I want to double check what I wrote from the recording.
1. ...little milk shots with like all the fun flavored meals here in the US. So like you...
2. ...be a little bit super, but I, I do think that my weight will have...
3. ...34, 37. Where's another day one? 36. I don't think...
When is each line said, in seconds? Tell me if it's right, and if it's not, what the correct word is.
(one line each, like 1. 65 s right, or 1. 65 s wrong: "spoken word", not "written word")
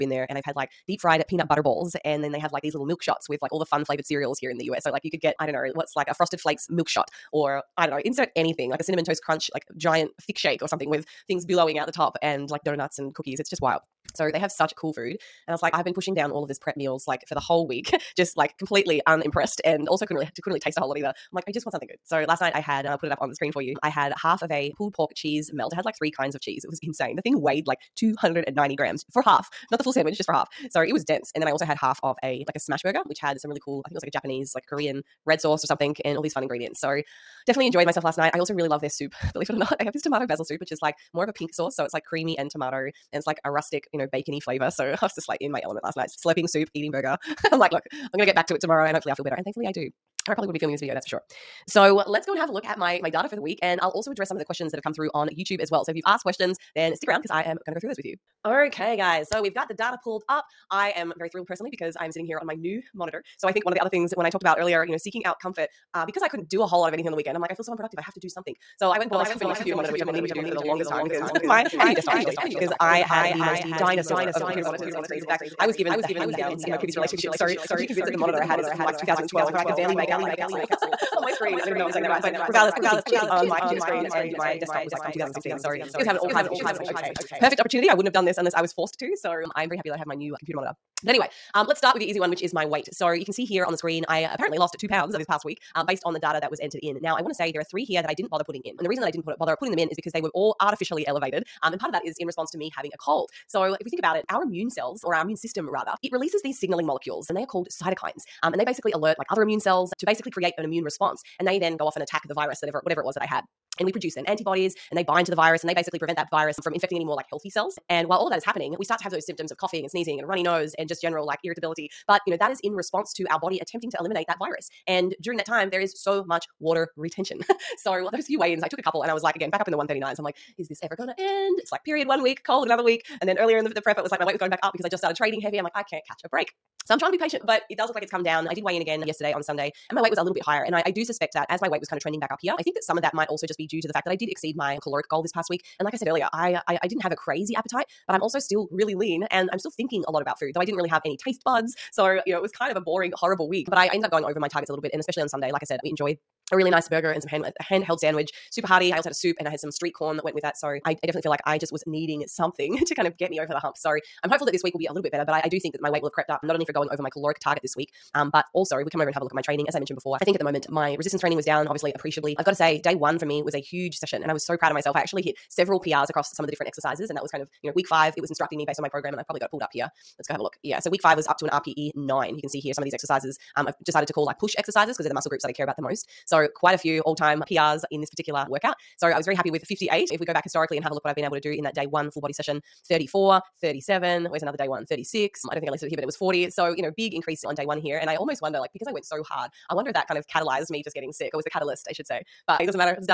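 1. 2 s wrong: "cereals", not "meals"
2. 164 s wrong: "better", not "super"
3. 192 s right.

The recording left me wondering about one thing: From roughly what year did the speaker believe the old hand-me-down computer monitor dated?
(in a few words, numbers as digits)
2012.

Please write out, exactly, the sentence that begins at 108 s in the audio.
Um, and they basically alert like other immune cells to basically create an immune response.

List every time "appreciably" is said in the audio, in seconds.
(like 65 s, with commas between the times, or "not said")
171 s.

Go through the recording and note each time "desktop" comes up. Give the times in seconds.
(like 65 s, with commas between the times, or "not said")
71 s, 84 s.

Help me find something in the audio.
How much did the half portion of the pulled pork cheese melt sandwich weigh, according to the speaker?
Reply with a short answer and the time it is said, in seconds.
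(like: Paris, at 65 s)
290 grams, at 27 s.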